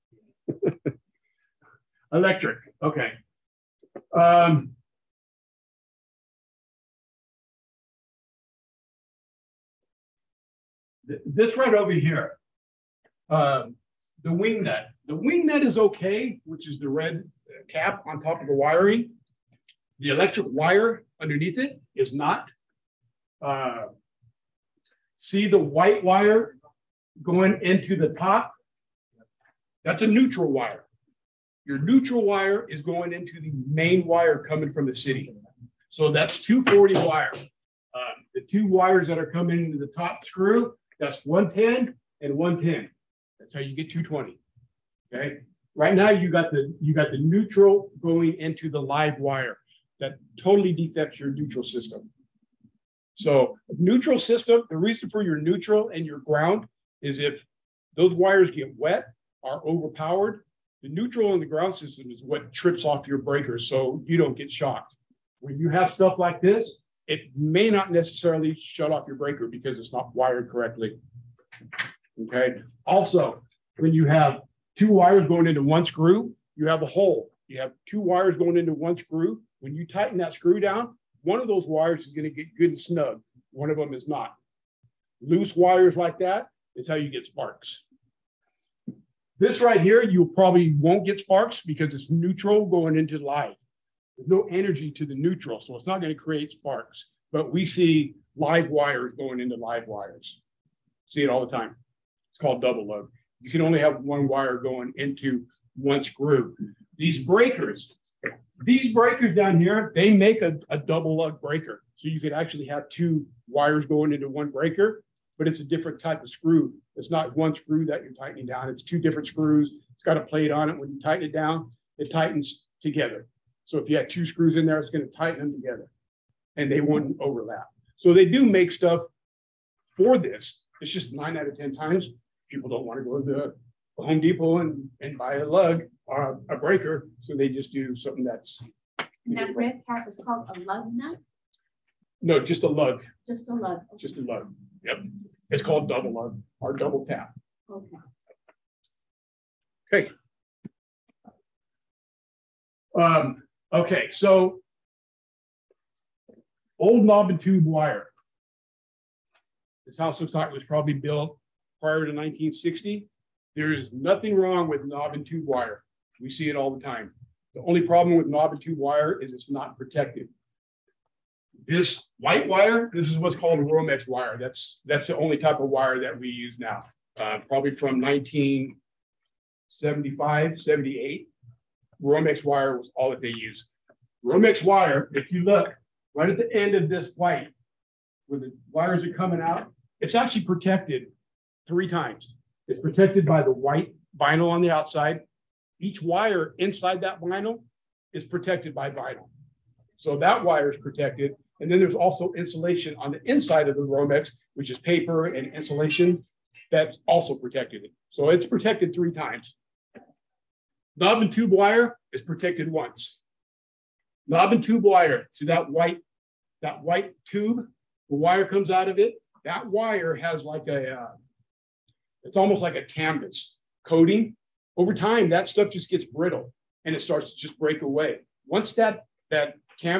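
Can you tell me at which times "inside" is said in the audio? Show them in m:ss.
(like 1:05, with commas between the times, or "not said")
3:16, 3:23.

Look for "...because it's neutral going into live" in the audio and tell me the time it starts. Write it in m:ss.
1:31.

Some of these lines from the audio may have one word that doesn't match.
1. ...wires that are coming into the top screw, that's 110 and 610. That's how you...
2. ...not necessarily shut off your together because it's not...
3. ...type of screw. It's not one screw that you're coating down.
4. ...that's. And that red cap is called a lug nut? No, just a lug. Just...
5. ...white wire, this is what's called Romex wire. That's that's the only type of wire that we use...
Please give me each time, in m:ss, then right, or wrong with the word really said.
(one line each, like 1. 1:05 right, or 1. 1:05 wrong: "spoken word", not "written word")
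1. 0:38 wrong: "110", not "610"
2. 1:07 wrong: "breaker", not "together"
3. 1:56 wrong: "tightening", not "coating"
4. 2:18 right
5. 2:52 right.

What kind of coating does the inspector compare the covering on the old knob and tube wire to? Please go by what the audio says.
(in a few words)
Canvas.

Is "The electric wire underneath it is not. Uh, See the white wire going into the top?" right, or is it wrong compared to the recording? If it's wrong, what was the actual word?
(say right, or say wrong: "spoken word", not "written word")
right.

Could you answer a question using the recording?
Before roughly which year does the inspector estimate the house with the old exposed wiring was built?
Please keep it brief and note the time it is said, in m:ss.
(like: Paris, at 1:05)
1960, at 2:41.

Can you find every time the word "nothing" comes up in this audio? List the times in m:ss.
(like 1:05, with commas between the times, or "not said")
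2:43.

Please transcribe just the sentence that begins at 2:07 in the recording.
So they do make stuff for this.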